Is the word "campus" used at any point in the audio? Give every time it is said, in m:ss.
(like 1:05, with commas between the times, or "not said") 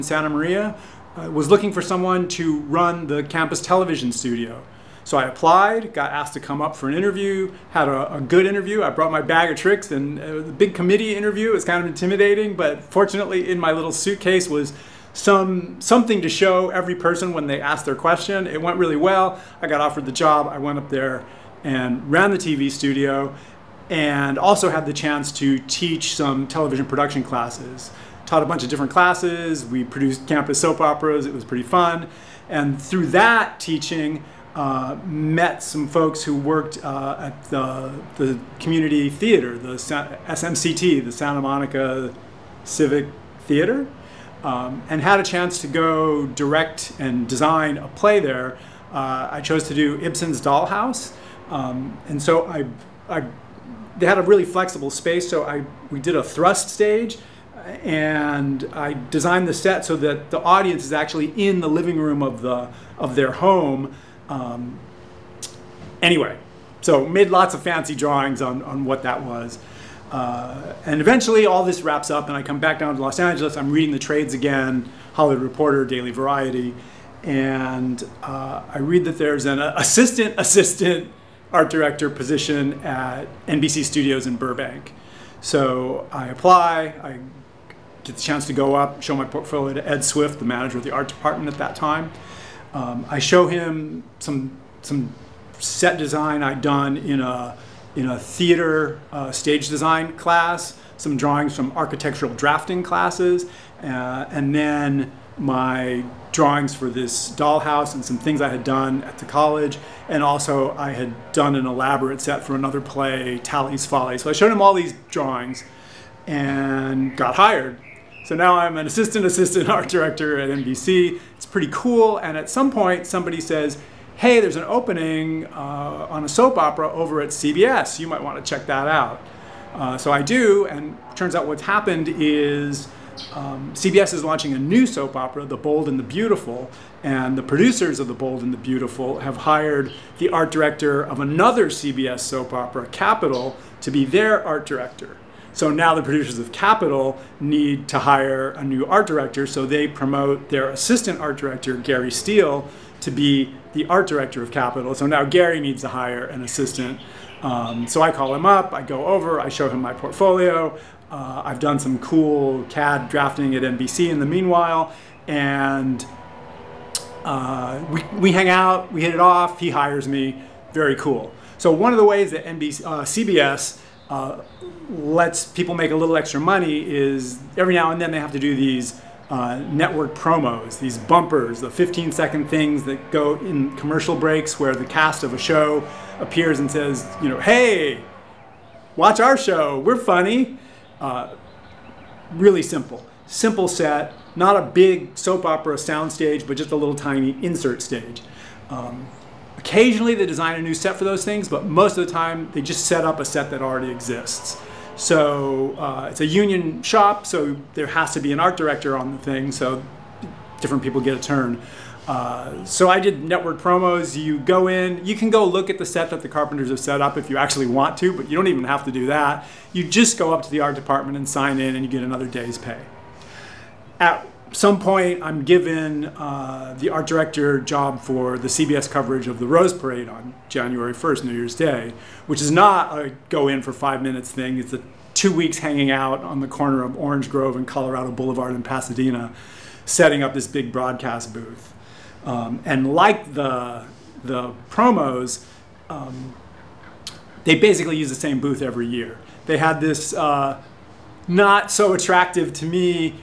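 0:03, 0:30.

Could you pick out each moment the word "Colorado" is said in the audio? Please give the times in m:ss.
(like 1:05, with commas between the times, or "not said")
3:57.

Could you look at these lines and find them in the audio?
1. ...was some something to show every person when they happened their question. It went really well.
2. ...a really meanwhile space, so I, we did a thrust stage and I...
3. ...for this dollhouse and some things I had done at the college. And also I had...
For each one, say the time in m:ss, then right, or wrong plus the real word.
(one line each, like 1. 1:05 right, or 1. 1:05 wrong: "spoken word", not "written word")
1. 0:14 wrong: "asked", not "happened"
2. 0:54 wrong: "flexible", not "meanwhile"
3. 1:46 right.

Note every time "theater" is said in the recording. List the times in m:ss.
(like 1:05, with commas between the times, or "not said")
0:39, 0:43, 1:38.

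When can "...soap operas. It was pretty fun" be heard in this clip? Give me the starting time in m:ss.
0:30.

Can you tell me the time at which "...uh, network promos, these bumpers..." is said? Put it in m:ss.
2:59.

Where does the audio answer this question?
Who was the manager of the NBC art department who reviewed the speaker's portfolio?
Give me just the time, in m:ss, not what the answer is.
1:29.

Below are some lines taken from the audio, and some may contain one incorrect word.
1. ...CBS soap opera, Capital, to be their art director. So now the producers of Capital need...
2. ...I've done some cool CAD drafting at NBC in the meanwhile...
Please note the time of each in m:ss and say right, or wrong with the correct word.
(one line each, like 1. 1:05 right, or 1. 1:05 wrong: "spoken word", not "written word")
1. 2:21 right
2. 2:41 right.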